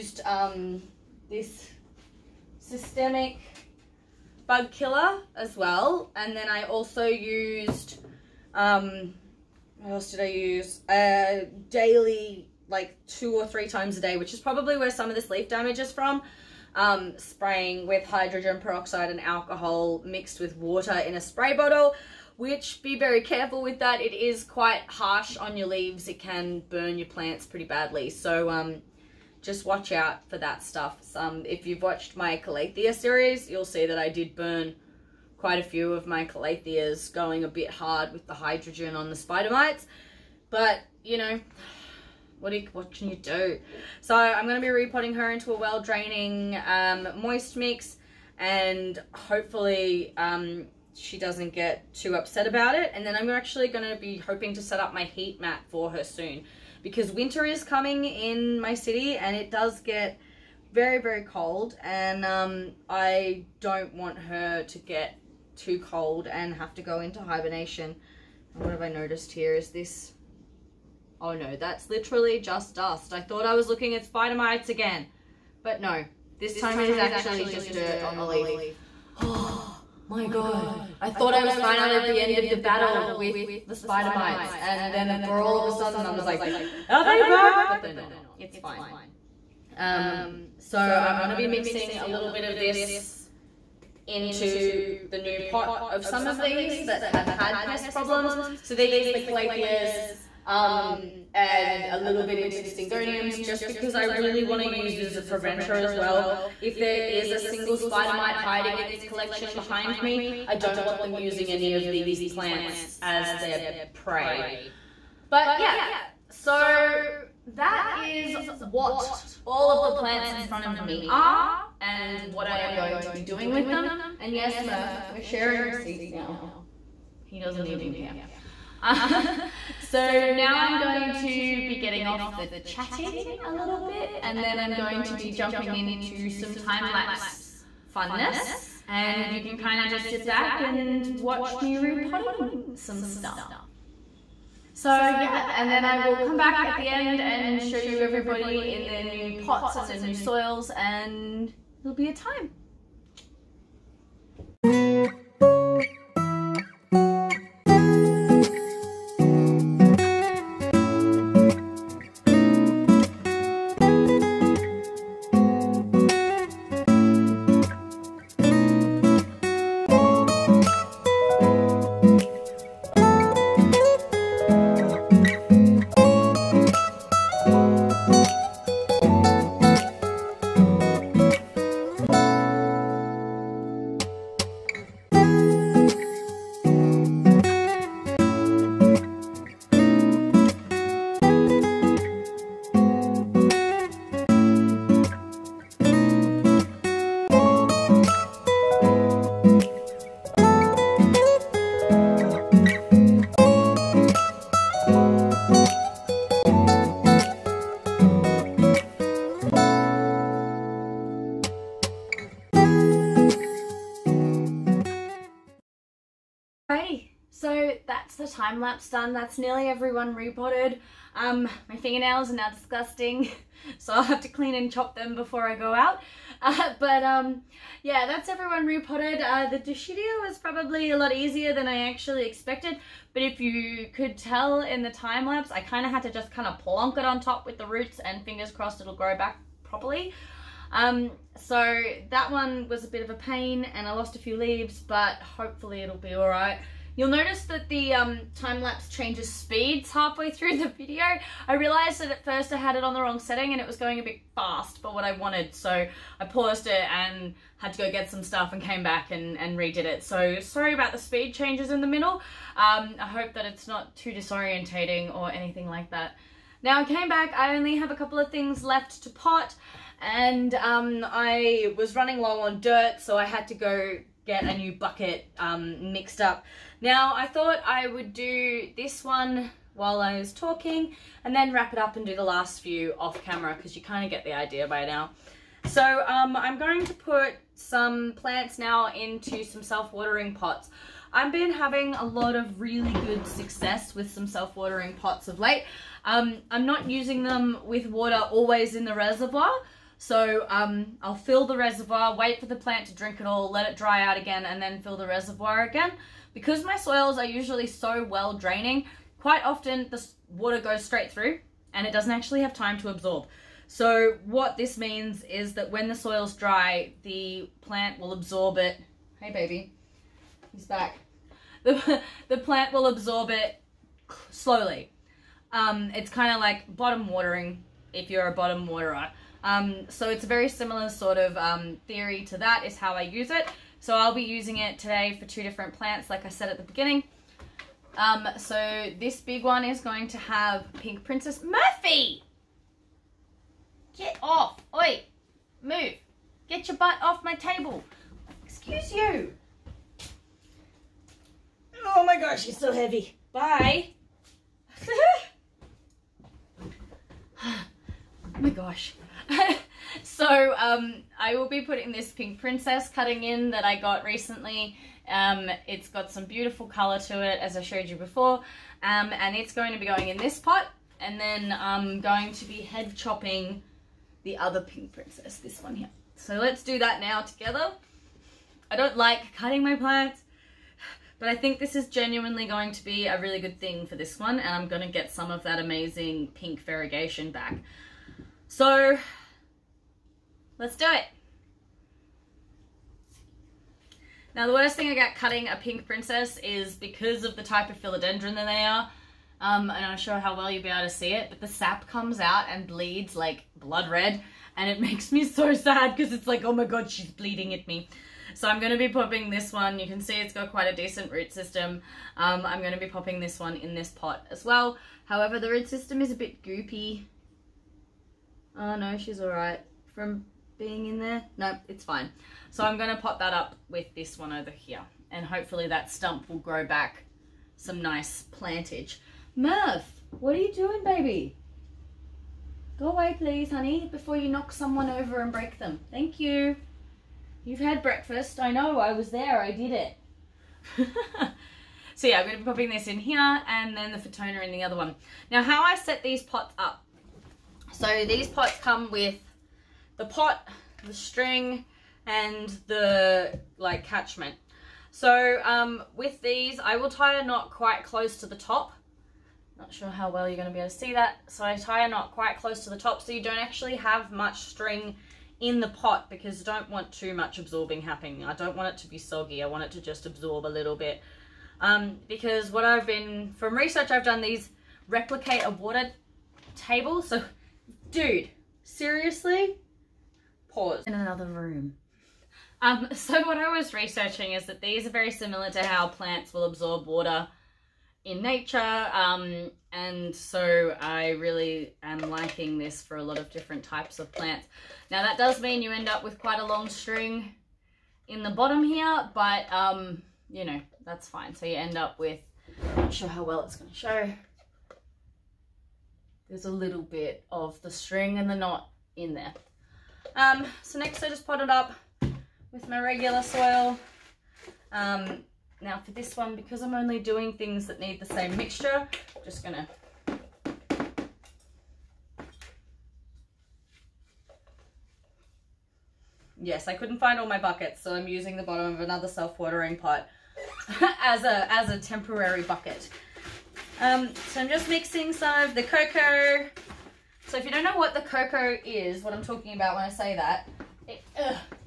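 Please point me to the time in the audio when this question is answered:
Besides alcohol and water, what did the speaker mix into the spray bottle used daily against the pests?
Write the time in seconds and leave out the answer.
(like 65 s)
18 s.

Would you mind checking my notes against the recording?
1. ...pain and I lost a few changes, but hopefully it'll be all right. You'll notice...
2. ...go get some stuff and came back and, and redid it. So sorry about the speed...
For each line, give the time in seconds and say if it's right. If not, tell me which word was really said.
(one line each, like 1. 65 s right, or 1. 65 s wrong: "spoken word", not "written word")
1. 243 s wrong: "leaves", not "changes"
2. 257 s right.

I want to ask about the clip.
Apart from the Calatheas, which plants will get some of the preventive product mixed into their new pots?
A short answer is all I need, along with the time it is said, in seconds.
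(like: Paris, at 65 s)
Syngoniums, at 102 s.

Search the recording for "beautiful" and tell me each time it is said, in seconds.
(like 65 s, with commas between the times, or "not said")
366 s.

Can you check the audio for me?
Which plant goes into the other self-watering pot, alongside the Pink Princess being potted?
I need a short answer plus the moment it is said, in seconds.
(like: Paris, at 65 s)
Fittonia, at 443 s.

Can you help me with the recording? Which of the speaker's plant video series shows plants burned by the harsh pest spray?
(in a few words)
Calathea series.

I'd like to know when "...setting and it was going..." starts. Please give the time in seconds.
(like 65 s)
253 s.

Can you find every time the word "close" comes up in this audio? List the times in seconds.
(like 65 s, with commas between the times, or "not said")
457 s, 462 s.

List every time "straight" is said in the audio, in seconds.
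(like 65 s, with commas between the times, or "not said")
310 s.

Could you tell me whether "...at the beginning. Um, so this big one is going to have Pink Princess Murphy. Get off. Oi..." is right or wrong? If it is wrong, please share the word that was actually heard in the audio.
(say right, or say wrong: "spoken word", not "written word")
right.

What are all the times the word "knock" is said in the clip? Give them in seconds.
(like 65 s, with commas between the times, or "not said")
434 s.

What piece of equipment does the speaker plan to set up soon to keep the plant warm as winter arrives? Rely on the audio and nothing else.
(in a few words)
heat mat.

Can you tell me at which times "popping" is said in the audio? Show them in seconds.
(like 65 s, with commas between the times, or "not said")
408 s, 412 s, 442 s.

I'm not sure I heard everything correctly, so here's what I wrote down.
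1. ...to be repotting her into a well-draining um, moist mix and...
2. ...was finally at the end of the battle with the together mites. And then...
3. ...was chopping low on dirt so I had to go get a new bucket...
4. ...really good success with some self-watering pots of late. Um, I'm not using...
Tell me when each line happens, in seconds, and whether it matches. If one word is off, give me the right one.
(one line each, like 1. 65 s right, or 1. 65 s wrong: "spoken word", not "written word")
1. 44 s right
2. 81 s wrong: "spider", not "together"
3. 271 s wrong: "running", not "chopping"
4. 292 s right.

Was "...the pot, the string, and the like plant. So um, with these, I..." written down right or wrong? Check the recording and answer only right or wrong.
wrong.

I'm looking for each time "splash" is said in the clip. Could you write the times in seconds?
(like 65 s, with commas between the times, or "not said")
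not said.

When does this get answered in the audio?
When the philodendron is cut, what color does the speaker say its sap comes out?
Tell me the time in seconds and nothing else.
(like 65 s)
403 s.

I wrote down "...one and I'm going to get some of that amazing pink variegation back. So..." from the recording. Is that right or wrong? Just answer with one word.
right.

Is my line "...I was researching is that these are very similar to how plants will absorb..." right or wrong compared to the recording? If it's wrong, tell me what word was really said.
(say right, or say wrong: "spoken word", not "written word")
right.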